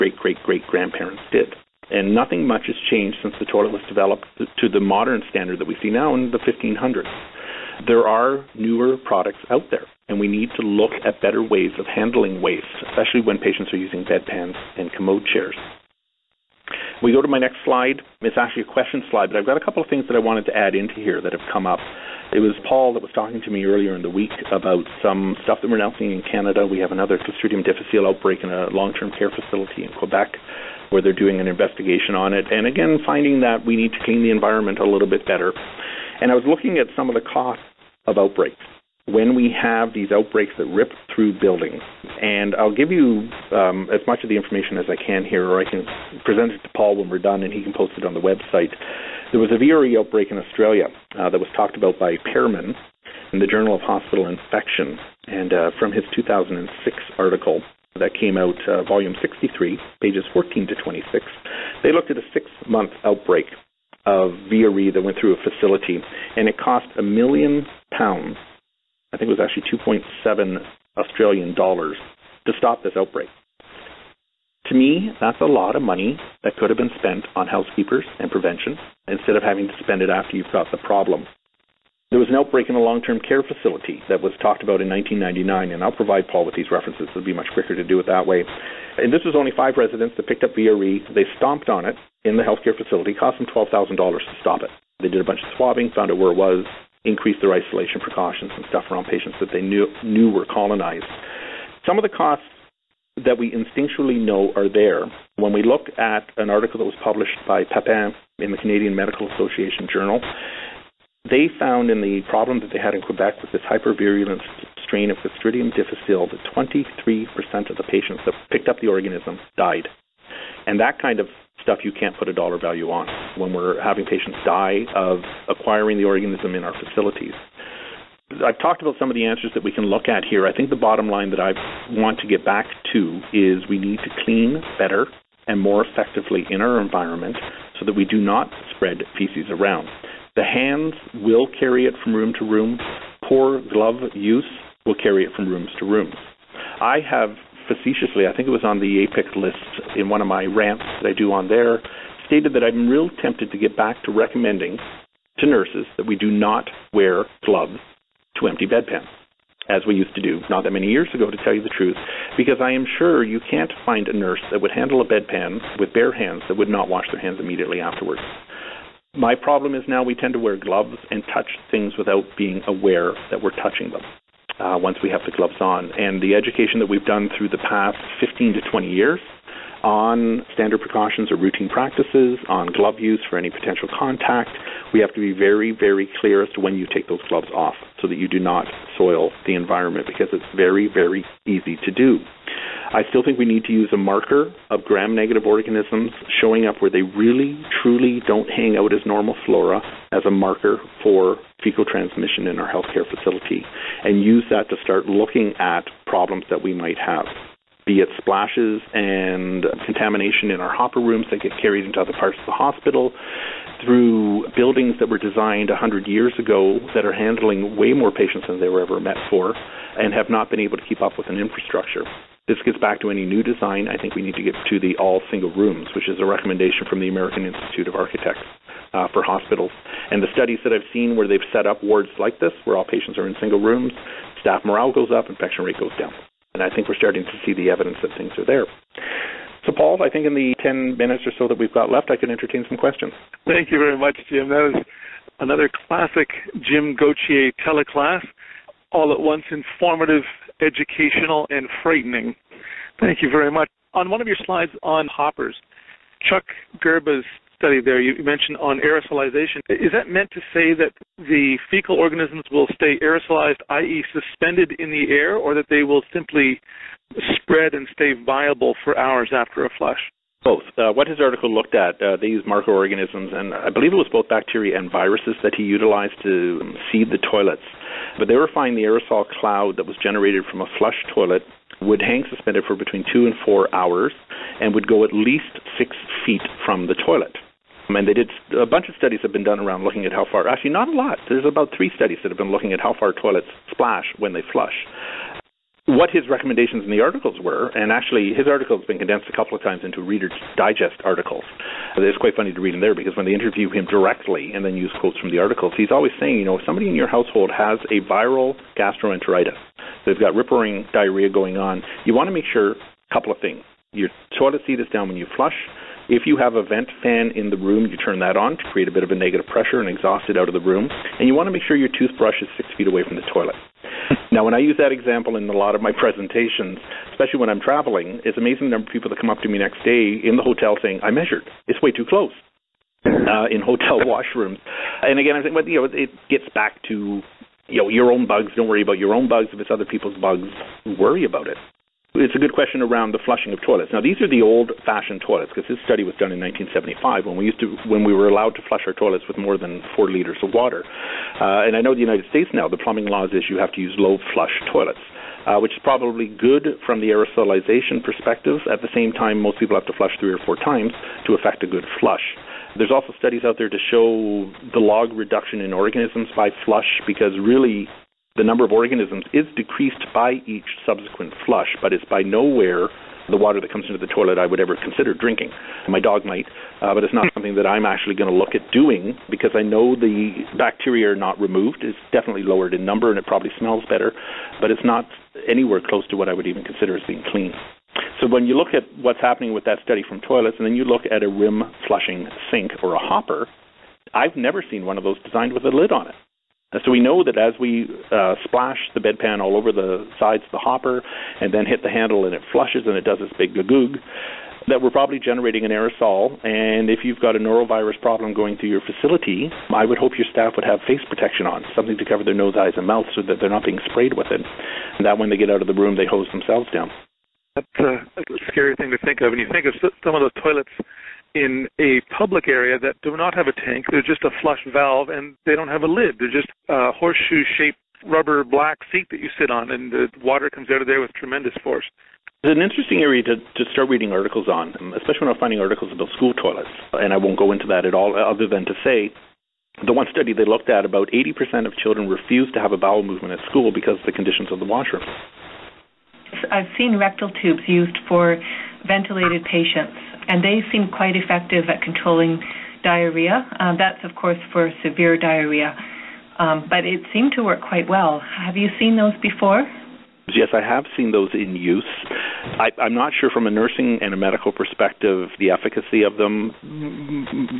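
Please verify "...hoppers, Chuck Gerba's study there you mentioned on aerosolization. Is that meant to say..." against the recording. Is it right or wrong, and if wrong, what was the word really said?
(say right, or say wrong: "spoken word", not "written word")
right.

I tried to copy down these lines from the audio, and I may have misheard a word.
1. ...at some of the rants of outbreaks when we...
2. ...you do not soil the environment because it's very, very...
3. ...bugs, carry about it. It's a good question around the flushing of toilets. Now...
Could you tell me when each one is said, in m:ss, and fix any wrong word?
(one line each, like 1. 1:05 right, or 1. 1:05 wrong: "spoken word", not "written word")
1. 0:36 wrong: "costs", not "rants"
2. 3:08 right
3. 5:40 wrong: "worry", not "carry".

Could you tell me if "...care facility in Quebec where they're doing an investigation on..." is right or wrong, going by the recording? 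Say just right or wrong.
right.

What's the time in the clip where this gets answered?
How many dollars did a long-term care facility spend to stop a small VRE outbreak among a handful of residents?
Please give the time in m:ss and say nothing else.
1:33.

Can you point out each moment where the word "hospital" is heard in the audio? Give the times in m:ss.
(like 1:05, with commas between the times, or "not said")
0:53, 3:32, 3:49.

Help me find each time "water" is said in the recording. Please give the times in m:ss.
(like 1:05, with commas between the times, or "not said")
5:50, 6:13, 7:10.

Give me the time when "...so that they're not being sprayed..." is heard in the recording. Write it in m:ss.
6:53.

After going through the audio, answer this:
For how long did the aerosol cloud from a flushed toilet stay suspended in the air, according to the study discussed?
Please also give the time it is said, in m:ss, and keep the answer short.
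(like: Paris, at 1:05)
2 to 4 hours, at 4:42.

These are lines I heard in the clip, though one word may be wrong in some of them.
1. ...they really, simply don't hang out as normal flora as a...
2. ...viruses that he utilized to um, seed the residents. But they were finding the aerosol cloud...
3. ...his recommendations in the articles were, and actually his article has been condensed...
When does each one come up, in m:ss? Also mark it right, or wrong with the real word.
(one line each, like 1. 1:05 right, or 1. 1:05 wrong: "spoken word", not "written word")
1. 3:16 wrong: "truly", not "simply"
2. 4:34 wrong: "toilets", not "residents"
3. 4:56 right.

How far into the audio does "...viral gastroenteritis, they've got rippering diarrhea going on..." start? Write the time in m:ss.
5:08.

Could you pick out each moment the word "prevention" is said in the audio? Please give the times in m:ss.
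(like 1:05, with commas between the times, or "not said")
1:18.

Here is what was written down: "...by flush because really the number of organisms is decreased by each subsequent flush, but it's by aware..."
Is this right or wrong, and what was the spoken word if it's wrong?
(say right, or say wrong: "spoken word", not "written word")
wrong: "nowhere", not "aware".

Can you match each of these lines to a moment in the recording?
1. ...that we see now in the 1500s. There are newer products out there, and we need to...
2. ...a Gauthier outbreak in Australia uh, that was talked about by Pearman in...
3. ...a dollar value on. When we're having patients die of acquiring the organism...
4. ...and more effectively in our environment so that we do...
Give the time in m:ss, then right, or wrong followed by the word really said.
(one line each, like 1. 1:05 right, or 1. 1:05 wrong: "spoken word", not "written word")
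1. 0:05 right
2. 0:49 wrong: "VRE", not "Gauthier"
3. 2:02 right
4. 2:15 right.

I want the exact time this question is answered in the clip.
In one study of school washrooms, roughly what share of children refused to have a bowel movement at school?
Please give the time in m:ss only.
7:21.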